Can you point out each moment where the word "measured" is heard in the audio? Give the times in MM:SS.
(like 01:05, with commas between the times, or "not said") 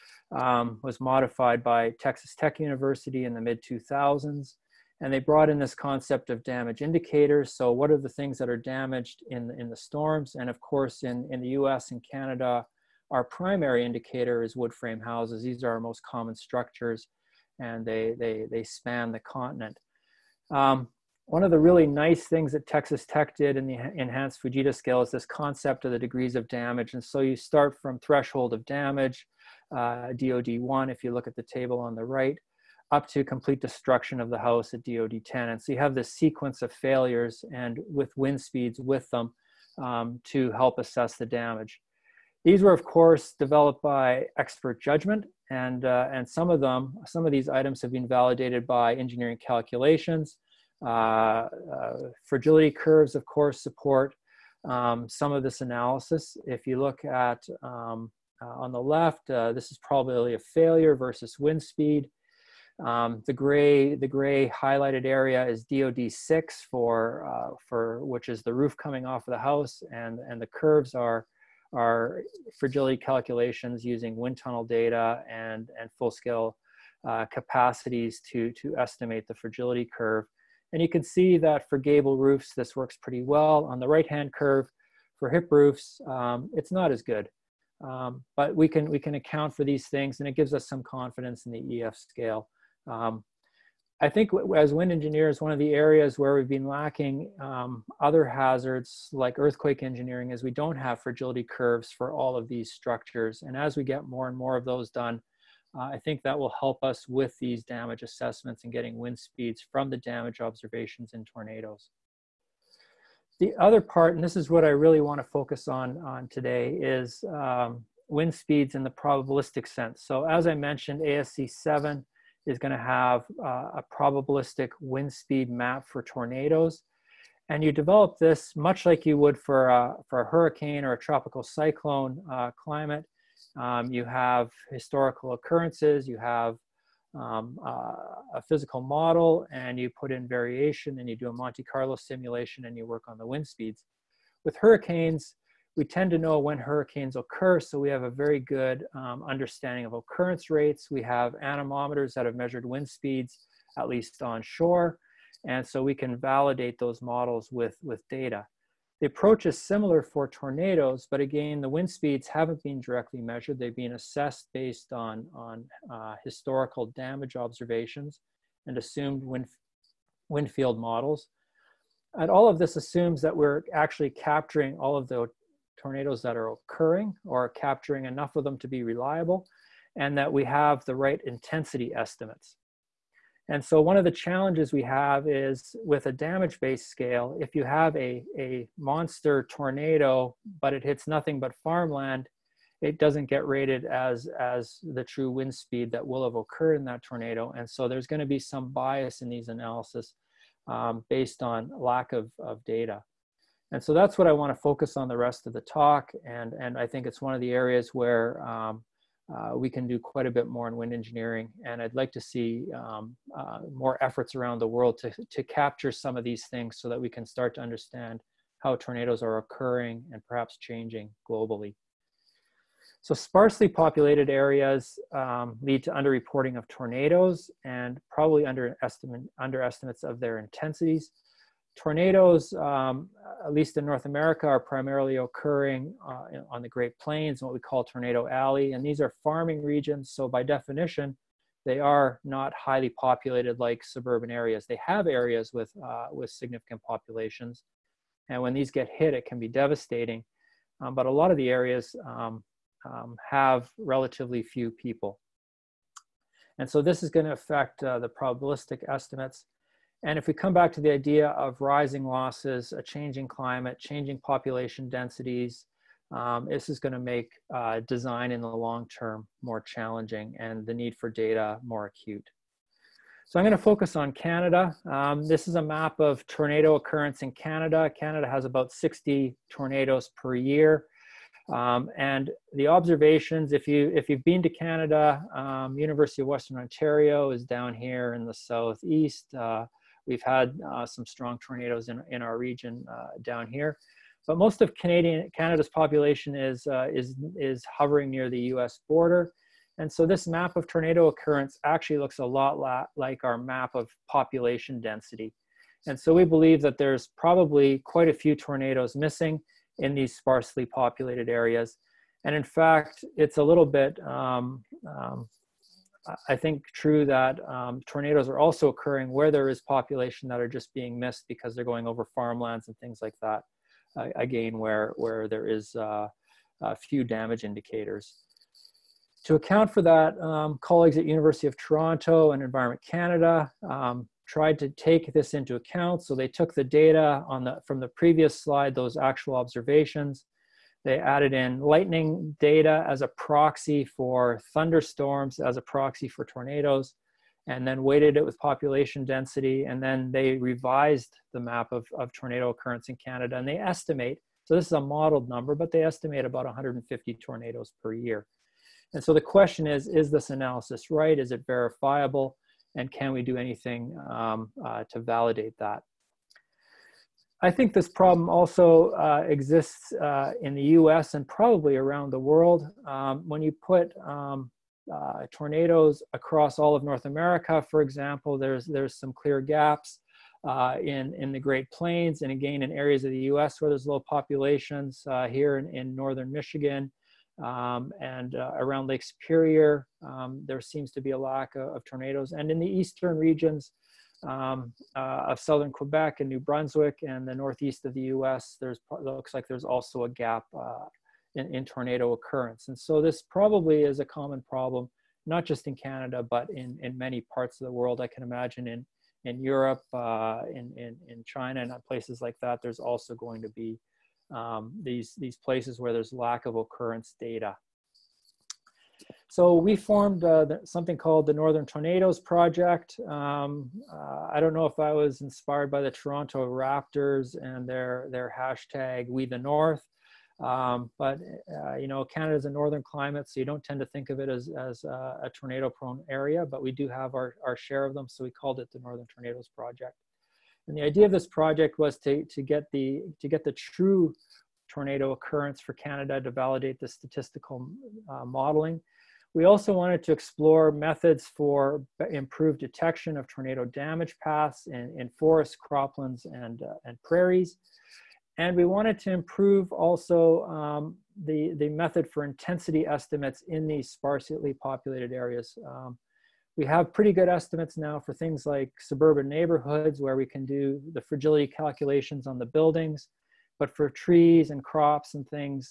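02:32, 02:43.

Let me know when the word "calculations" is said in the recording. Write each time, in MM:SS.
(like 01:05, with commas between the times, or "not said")
00:49, 01:12, 07:51.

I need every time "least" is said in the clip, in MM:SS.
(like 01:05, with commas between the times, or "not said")
02:33, 03:53.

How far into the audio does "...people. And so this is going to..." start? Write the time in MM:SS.
04:14.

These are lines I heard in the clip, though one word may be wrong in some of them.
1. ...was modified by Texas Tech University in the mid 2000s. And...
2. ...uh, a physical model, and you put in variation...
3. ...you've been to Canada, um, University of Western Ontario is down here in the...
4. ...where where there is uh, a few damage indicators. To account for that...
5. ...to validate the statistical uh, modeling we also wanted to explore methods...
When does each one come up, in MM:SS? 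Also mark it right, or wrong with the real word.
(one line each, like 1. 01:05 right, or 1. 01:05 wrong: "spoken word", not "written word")
1. 00:00 right
2. 02:17 right
3. 04:44 right
4. 05:24 right
5. 07:26 right.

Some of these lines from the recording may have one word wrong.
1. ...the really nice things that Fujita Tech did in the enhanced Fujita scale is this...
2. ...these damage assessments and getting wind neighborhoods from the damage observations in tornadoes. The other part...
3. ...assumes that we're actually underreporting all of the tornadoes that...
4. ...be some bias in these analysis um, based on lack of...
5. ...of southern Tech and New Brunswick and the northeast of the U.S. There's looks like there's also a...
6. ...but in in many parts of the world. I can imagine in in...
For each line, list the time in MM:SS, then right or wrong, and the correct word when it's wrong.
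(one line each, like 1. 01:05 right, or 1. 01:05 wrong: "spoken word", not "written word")
1. 00:21 wrong: "Texas", not "Fujita"
2. 01:47 wrong: "speeds", not "neighborhoods"
3. 02:52 wrong: "capturing", not "underreporting"
4. 03:18 right
5. 06:35 wrong: "Quebec", not "Tech"
6. 06:46 right.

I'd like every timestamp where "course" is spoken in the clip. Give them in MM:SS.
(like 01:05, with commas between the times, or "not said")
00:10, 00:42, 00:53.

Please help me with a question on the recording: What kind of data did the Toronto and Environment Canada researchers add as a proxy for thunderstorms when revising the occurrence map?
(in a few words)
lightning data.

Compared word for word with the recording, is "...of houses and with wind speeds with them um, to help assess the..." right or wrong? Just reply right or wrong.
wrong.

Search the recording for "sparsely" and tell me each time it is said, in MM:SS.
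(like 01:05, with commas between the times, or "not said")
03:43, 05:10, 07:43.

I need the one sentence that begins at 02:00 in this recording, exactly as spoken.
So as I mentioned, ASCE 7, is going to have uh, a probabilistic wind speed map for tornadoes.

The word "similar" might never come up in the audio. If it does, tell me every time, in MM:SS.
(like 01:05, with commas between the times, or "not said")
02:39.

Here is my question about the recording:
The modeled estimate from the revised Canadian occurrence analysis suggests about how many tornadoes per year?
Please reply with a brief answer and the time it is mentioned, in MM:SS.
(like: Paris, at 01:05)
150, at 05:56.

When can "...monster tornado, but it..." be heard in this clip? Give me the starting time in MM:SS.
03:08.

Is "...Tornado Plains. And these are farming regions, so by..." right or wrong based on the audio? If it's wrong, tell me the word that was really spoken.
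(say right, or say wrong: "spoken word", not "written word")
wrong: "Alley", not "Plains".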